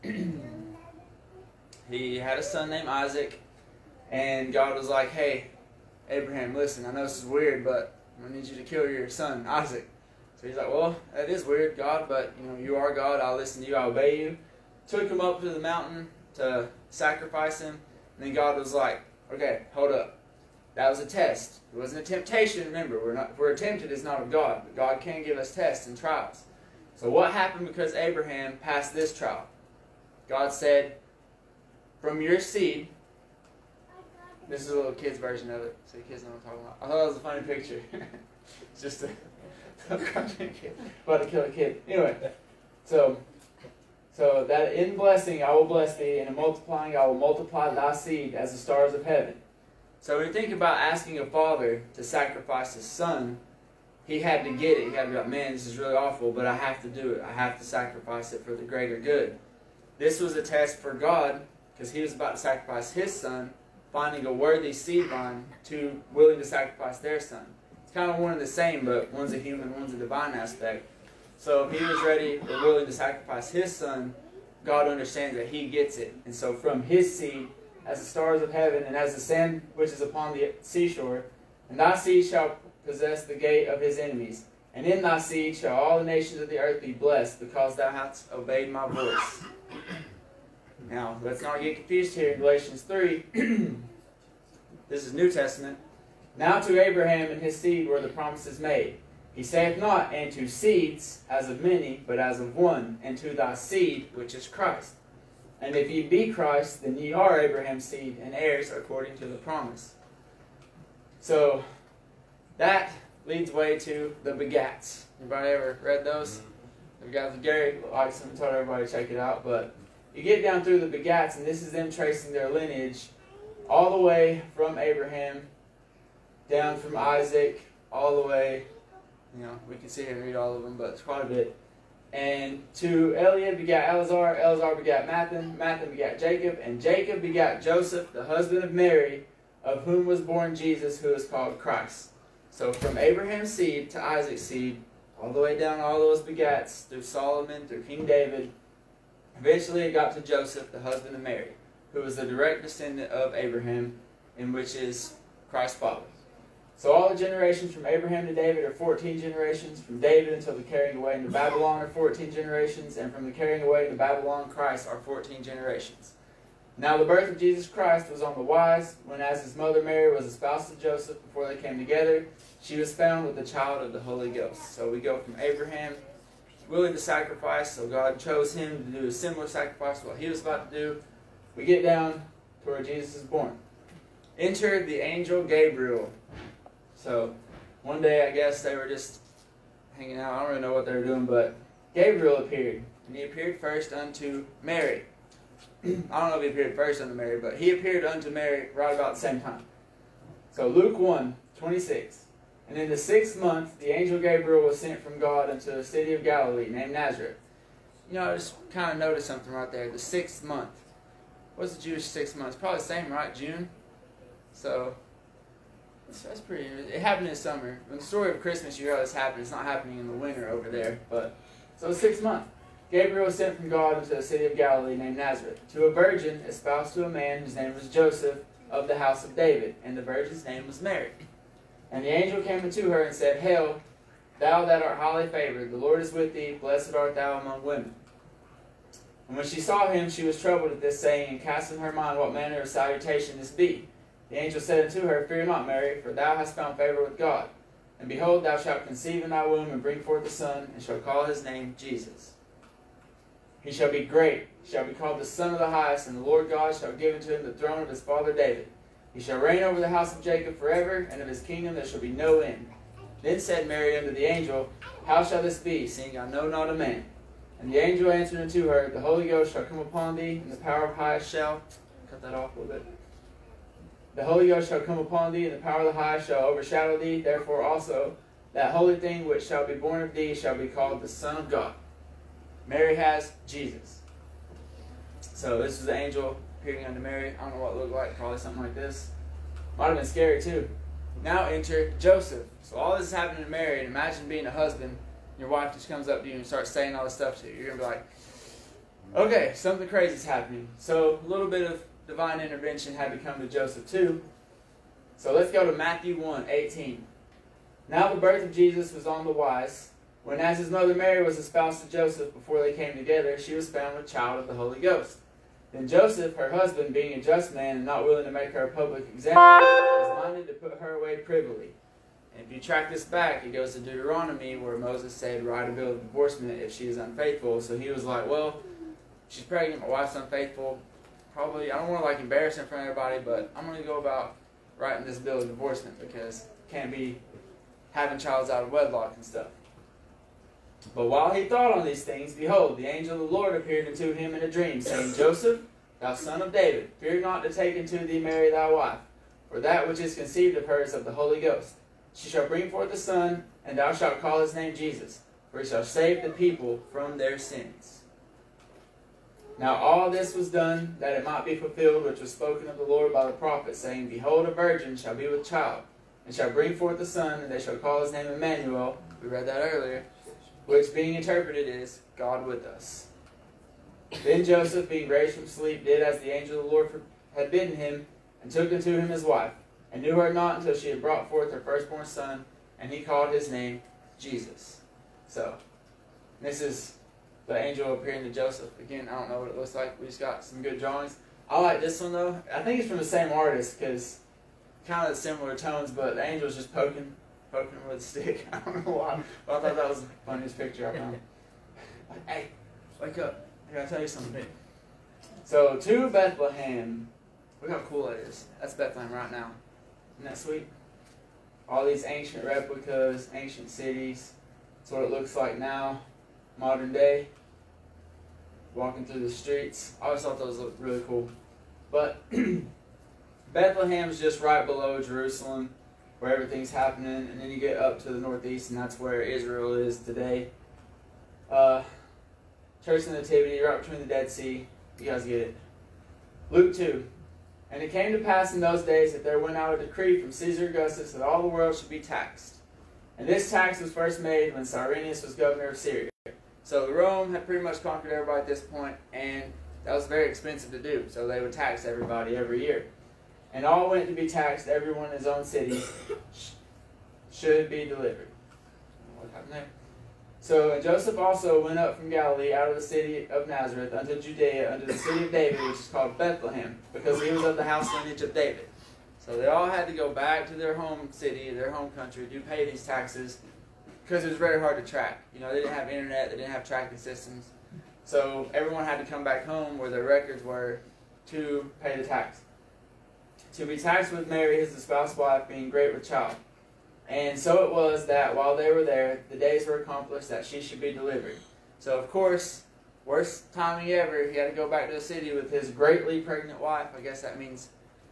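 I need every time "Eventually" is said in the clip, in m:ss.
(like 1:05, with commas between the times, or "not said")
2:29.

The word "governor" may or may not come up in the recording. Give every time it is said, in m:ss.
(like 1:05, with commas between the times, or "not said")
7:25.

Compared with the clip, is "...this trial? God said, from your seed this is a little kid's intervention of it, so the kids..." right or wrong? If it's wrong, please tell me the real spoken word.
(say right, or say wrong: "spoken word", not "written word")
wrong: "version", not "intervention".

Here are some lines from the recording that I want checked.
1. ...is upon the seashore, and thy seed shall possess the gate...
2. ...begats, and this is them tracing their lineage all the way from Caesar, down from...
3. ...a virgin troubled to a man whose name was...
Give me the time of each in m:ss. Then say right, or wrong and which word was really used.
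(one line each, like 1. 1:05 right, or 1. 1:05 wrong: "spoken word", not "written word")
1. 1:19 right
2. 2:00 wrong: "Abraham", not "Caesar"
3. 3:45 wrong: "espoused", not "troubled".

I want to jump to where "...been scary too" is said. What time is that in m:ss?
4:49.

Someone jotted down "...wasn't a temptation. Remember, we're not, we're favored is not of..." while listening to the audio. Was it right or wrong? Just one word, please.
wrong.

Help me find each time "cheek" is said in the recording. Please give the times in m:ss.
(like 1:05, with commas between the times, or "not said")
not said.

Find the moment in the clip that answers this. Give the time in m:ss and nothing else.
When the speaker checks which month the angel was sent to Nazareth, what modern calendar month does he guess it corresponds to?
3:33.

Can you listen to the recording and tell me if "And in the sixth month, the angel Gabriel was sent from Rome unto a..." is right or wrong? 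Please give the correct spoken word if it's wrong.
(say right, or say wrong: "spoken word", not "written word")
wrong: "God", not "Rome".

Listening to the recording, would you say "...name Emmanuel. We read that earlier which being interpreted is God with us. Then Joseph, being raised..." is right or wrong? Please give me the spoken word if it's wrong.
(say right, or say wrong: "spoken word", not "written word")
right.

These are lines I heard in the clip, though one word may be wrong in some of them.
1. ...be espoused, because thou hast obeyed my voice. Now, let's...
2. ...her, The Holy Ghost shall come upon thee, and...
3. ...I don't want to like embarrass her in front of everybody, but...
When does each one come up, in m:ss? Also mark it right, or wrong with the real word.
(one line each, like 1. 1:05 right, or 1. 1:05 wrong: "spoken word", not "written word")
1. 1:26 wrong: "blessed", not "espoused"
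2. 4:28 right
3. 5:31 right.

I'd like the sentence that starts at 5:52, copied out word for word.
She shall bring forth a son, and thou shalt call his name Jesus, for he shall save the people from their sins.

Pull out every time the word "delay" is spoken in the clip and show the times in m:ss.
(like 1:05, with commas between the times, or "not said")
not said.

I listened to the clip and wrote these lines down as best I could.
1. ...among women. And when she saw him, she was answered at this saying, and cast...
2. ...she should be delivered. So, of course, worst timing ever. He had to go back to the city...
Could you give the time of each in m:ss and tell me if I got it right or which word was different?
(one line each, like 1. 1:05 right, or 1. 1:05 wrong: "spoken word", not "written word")
1. 3:57 wrong: "troubled", not "answered"
2. 8:10 right.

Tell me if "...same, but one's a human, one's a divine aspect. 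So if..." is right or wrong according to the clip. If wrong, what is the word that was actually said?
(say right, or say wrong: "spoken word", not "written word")
right.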